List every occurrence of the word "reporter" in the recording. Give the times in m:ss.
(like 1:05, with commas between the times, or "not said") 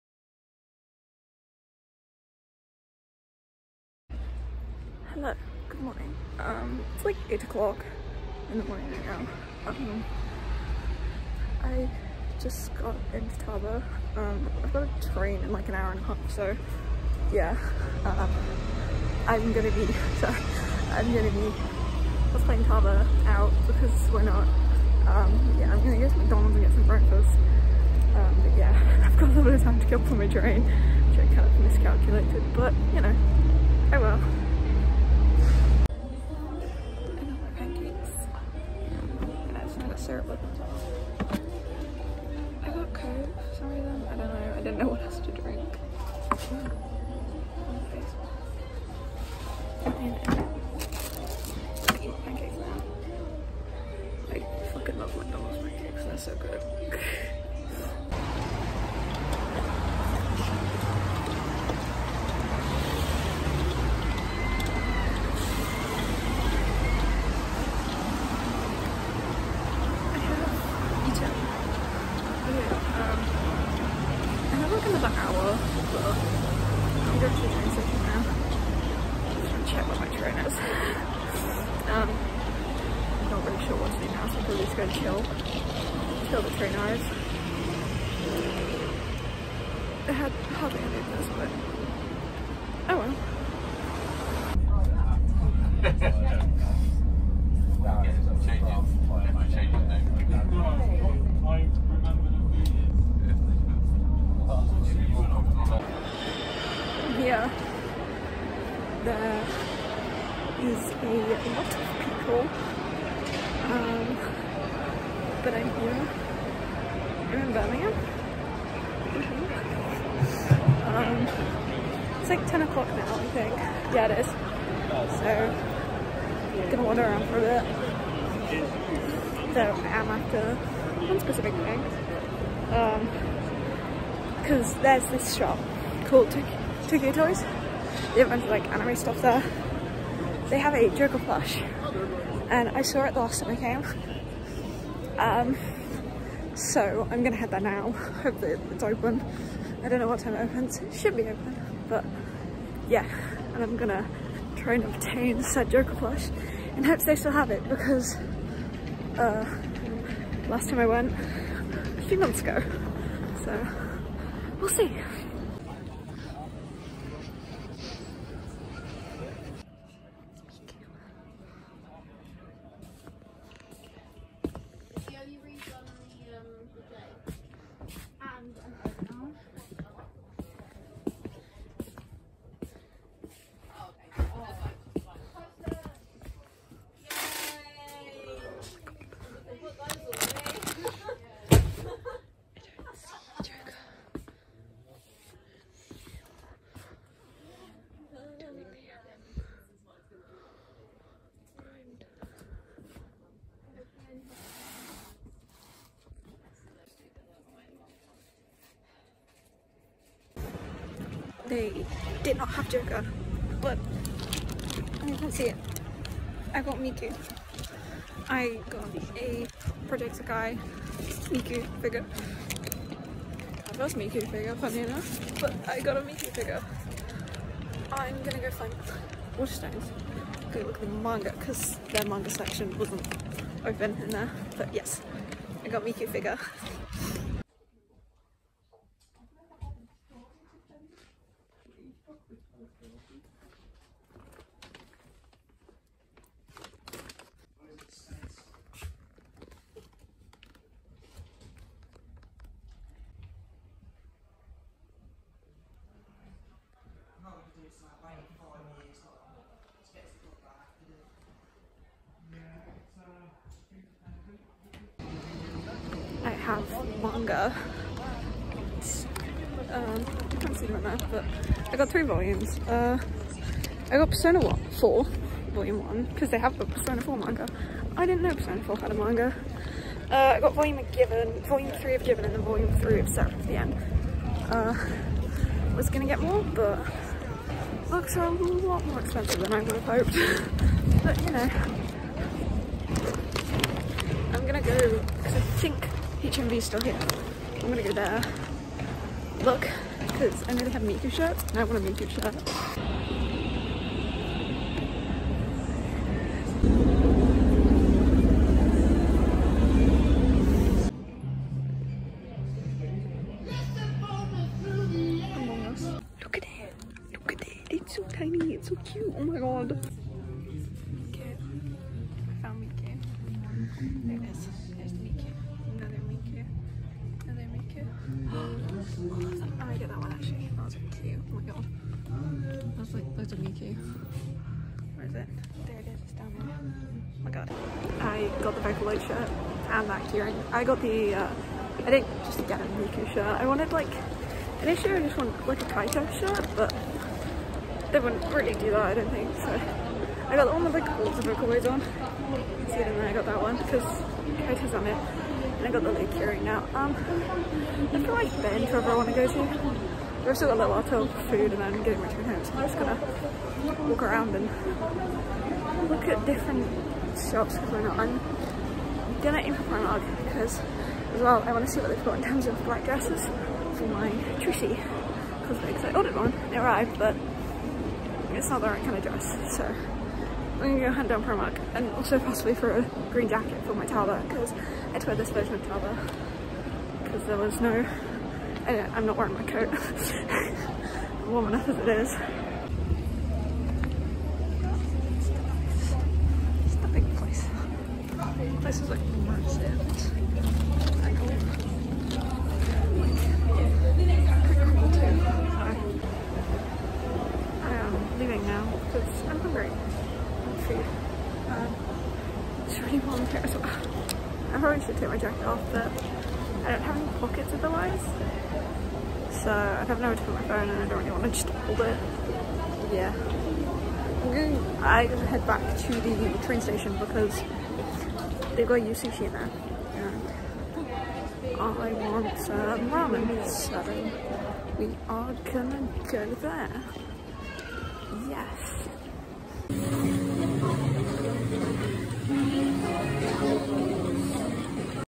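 not said.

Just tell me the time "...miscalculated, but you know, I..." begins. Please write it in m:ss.
0:31.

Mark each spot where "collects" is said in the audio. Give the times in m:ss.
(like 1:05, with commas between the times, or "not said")
not said.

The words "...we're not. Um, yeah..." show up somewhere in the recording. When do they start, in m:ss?
0:24.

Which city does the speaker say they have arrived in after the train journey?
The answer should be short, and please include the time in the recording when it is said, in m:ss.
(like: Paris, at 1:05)
Birmingham, at 1:57.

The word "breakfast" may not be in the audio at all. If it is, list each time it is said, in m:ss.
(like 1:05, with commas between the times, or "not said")
0:26.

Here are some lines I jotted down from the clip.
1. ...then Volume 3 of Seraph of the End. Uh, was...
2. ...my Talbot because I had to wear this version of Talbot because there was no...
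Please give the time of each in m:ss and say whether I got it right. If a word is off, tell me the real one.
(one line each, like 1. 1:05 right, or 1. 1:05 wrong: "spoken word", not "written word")
1. 4:42 right
2. 6:23 right.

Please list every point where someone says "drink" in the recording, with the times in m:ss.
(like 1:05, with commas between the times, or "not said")
0:45.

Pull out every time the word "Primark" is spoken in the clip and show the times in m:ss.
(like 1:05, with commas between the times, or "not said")
6:09, 6:21.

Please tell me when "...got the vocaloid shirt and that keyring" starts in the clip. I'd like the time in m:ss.
5:38.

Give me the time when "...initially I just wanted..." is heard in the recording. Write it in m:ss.
5:44.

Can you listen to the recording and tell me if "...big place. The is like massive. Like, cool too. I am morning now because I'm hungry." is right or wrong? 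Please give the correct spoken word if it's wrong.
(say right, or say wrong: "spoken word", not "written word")
wrong: "leaving", not "morning".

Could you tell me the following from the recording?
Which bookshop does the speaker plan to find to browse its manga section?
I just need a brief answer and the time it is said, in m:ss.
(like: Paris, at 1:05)
Waterstones, at 3:49.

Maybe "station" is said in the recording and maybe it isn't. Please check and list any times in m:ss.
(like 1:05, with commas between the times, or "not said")
1:17, 7:06.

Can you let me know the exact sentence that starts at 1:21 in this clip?
um, I'm not really sure what to do now, so I'm probably just going to chill.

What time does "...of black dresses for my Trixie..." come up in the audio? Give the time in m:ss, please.
6:12.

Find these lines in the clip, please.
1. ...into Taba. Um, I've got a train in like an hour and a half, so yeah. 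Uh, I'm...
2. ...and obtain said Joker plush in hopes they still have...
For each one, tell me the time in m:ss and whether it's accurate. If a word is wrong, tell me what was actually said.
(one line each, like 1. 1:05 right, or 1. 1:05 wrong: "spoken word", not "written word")
1. 0:13 right
2. 2:34 right.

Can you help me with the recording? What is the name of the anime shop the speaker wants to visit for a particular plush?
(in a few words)
Tokyo Toys.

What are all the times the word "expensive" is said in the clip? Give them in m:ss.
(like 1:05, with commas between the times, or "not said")
4:49.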